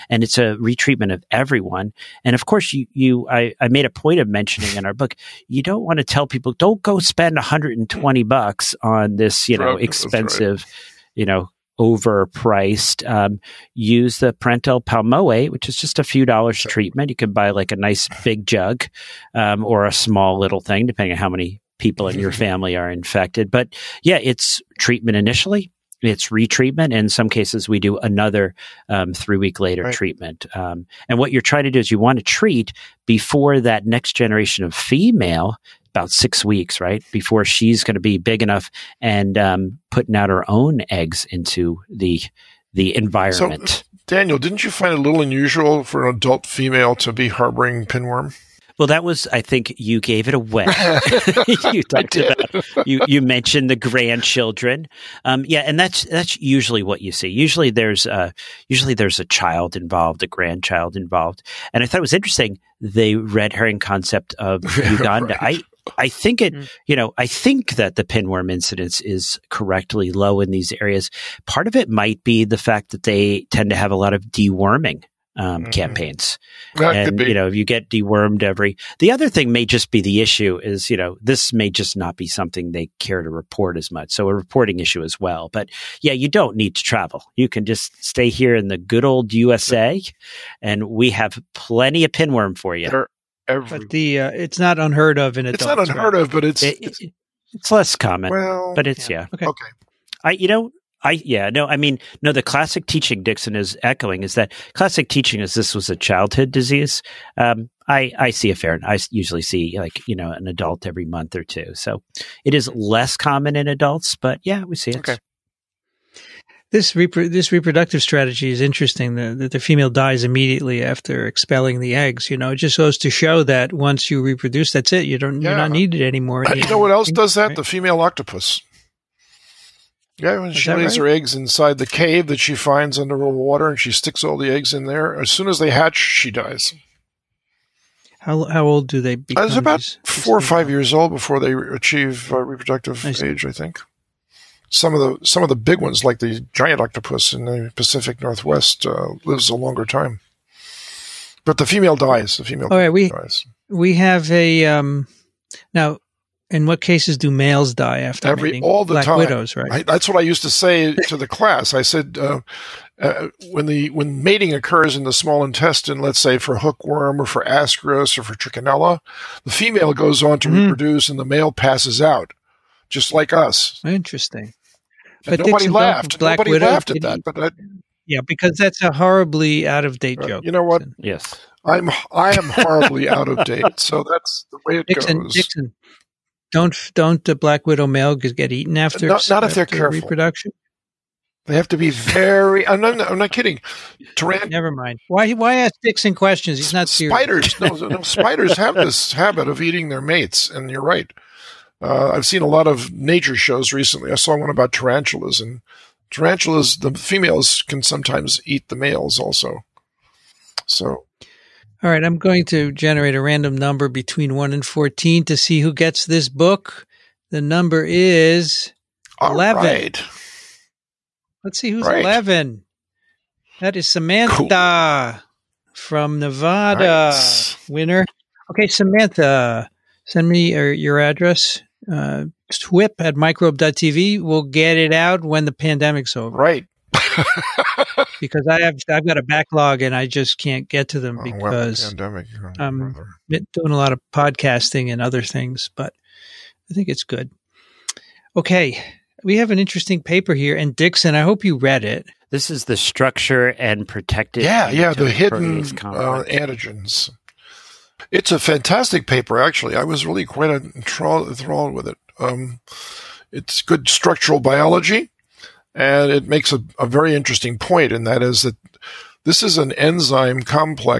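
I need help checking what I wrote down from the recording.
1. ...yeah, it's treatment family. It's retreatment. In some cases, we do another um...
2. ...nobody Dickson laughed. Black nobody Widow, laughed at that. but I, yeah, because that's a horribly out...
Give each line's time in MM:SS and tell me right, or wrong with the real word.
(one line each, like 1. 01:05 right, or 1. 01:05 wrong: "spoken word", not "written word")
1. 00:24 wrong: "initially", not "family"
2. 02:55 right.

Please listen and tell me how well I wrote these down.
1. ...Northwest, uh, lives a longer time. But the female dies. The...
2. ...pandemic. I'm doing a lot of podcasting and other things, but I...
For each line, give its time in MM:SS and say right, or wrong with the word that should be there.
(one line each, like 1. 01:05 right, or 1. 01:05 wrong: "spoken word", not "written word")
1. 02:28 right
2. 04:01 right.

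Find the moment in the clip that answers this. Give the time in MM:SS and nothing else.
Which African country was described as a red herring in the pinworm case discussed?
01:04.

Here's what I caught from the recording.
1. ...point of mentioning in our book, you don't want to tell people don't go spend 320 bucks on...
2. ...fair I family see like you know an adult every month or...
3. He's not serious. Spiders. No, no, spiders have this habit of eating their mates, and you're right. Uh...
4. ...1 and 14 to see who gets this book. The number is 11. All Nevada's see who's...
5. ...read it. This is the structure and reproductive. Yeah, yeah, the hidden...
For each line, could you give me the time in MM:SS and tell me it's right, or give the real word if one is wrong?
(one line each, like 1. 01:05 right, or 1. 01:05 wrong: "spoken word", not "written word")
1. 00:03 wrong: "120", not "320"
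2. 01:48 wrong: "usually", not "family"
3. 03:16 right
4. 03:34 wrong: "Let", not "Nevada"
5. 04:11 wrong: "protective", not "reproductive".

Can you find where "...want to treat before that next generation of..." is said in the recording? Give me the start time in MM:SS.
00:31.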